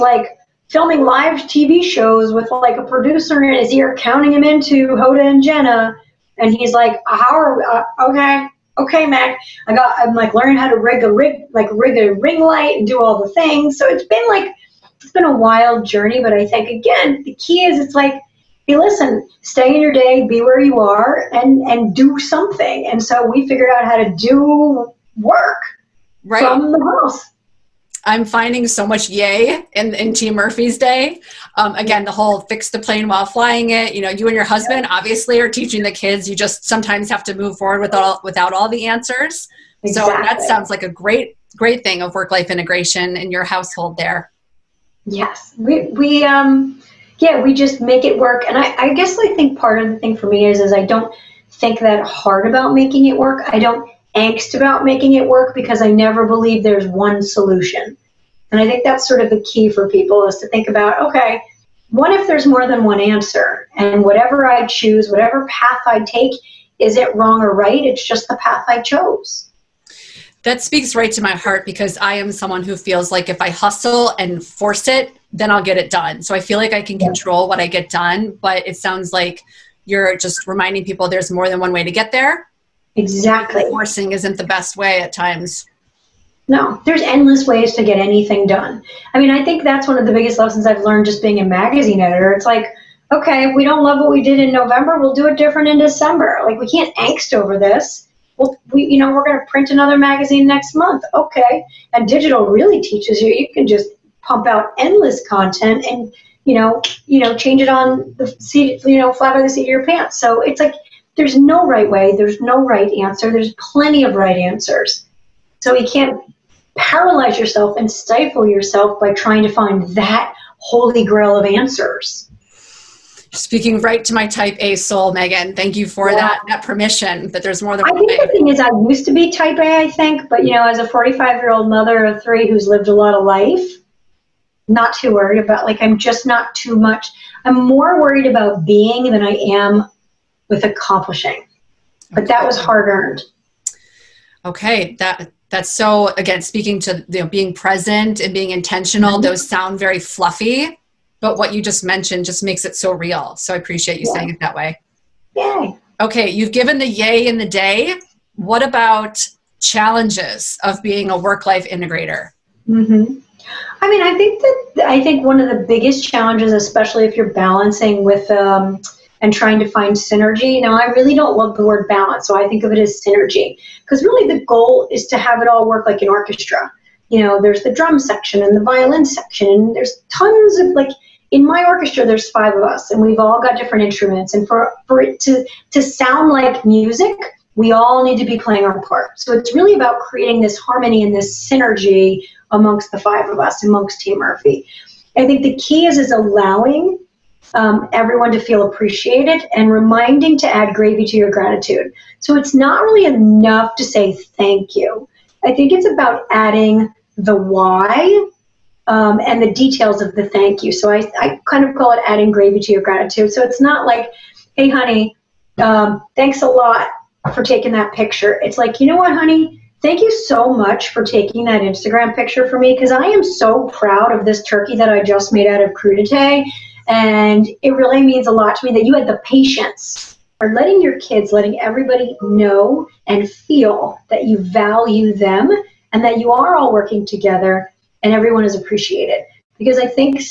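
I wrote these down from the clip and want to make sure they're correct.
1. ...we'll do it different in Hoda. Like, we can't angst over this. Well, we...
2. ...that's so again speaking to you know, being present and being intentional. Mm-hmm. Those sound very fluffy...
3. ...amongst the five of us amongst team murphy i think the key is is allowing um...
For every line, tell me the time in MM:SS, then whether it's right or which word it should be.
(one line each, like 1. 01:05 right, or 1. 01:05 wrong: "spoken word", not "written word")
1. 01:34 wrong: "December", not "Hoda"
2. 02:25 right
3. 03:12 right.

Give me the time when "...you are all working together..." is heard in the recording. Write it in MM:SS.
03:56.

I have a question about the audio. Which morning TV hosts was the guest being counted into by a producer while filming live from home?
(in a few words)
Hoda and Jenna.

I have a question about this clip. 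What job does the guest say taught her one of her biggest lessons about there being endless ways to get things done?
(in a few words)
magazine editor.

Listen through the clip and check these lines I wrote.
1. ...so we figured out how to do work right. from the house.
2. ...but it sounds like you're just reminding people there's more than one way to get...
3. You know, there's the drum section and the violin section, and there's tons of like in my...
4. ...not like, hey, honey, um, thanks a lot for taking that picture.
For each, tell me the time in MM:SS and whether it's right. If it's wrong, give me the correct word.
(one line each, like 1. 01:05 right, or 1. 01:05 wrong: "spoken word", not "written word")
1. 00:23 right
2. 01:18 right
3. 02:57 right
4. 03:33 right.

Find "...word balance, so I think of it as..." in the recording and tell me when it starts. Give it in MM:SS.
02:51.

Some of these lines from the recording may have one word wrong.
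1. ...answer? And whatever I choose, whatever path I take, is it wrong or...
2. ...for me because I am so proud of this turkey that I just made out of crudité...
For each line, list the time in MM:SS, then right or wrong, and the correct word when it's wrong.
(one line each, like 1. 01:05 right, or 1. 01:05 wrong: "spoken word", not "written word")
1. 01:02 right
2. 03:42 right.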